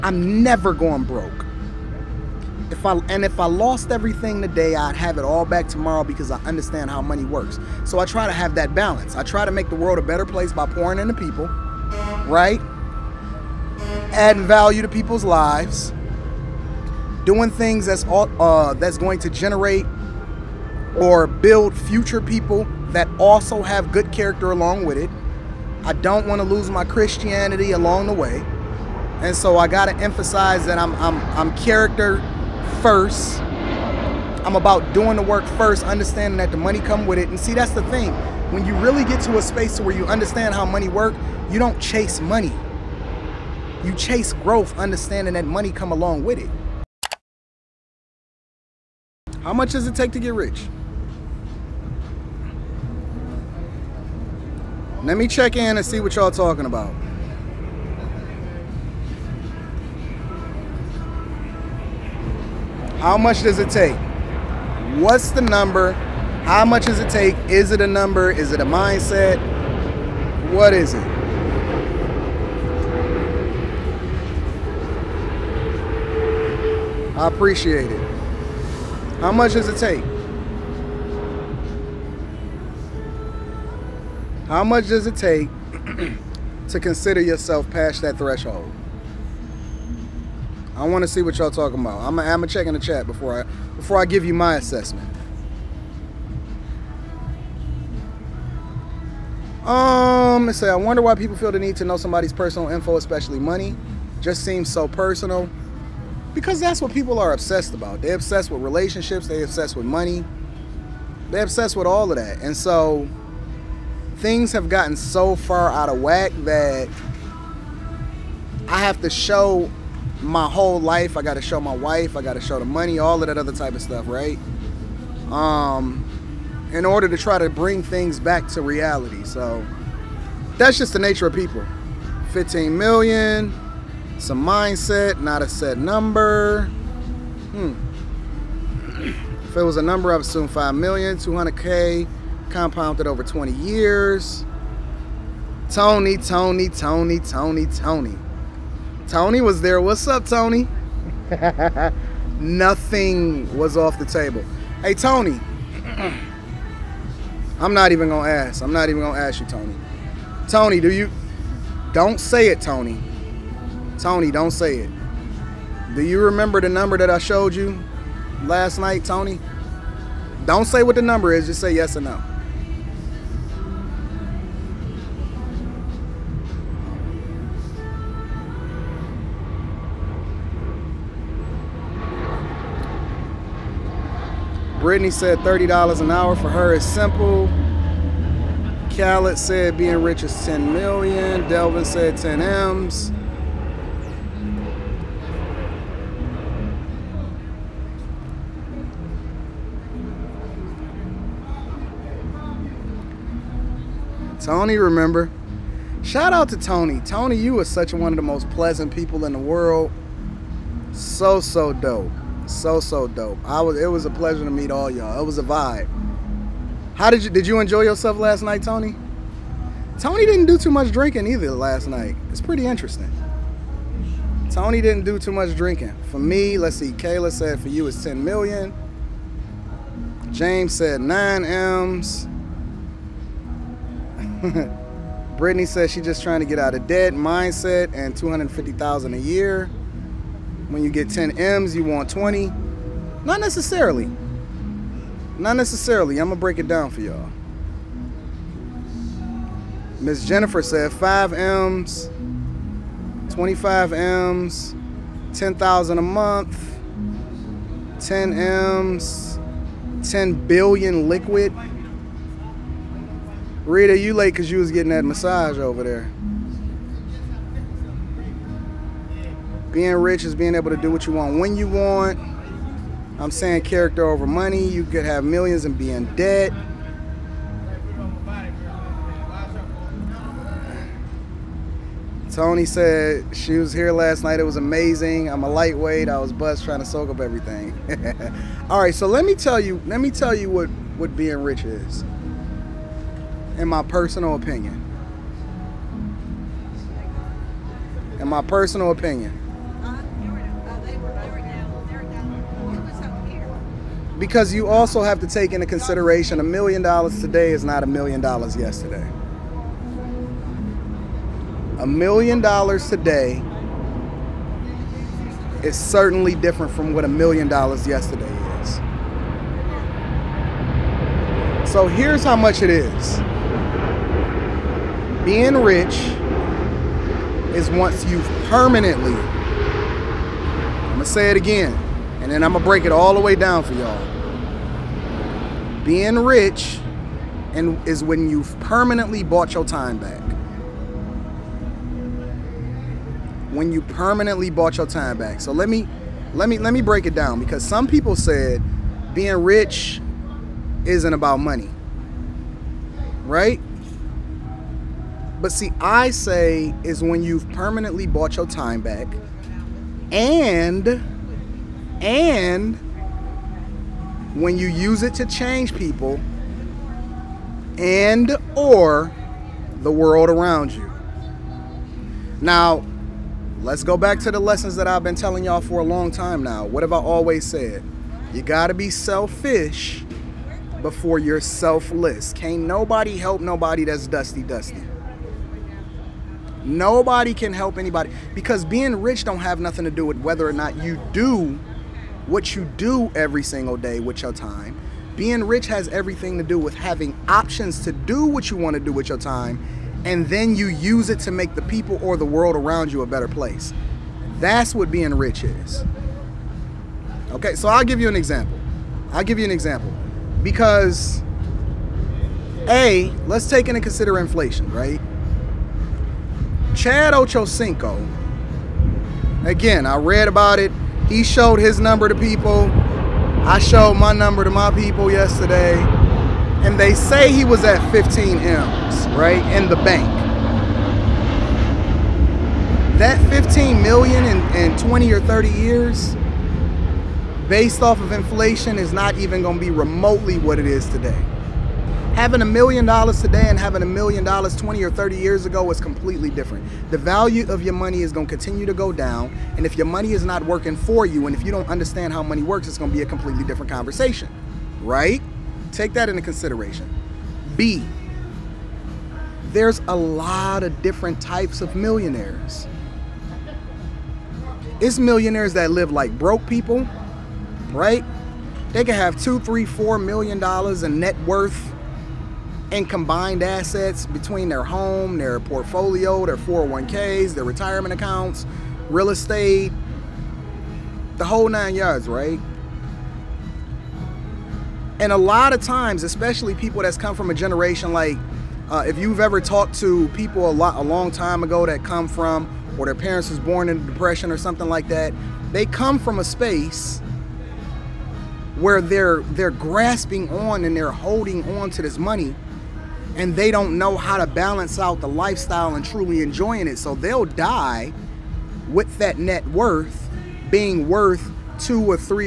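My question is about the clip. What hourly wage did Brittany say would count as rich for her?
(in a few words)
$30 an hour.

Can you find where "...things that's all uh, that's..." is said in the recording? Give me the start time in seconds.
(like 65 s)
17 s.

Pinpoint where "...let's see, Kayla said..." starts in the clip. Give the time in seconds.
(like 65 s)
226 s.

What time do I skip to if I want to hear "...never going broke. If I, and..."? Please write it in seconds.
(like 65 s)
0 s.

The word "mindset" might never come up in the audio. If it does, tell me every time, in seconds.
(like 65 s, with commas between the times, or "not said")
68 s, 134 s, 237 s.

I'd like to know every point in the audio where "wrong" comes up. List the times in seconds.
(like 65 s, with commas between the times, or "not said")
not said.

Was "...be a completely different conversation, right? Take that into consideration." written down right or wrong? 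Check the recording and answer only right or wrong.
right.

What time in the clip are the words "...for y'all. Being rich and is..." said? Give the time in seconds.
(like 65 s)
333 s.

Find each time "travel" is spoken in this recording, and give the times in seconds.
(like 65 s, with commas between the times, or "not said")
not said.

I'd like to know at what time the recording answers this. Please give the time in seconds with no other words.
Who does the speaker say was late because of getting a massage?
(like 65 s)
263 s.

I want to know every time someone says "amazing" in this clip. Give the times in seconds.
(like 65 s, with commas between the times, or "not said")
284 s.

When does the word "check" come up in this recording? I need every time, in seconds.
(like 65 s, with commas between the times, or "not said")
55 s, 92 s.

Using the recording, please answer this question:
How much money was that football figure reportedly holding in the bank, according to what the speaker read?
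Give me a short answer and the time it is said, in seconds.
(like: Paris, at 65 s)
15 M's, at 427 s.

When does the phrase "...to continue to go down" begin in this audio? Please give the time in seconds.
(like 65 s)
448 s.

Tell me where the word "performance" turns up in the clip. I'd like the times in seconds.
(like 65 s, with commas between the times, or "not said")
not said.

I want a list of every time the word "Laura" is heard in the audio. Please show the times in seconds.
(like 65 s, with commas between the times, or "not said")
not said.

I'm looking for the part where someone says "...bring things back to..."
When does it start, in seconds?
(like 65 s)
127 s.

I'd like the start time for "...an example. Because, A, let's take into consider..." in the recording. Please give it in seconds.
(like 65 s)
409 s.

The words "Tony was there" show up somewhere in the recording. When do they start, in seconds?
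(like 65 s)
149 s.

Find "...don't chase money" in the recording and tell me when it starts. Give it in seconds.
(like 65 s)
41 s.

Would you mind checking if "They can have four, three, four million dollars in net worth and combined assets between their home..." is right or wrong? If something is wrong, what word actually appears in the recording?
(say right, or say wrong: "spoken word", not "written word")
wrong: "two", not "four".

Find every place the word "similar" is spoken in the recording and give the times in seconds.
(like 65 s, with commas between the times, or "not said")
not said.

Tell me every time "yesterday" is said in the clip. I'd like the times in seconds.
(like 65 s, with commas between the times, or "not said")
308 s, 317 s, 425 s.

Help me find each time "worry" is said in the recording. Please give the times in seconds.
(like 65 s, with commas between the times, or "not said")
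not said.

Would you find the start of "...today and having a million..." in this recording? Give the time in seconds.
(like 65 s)
443 s.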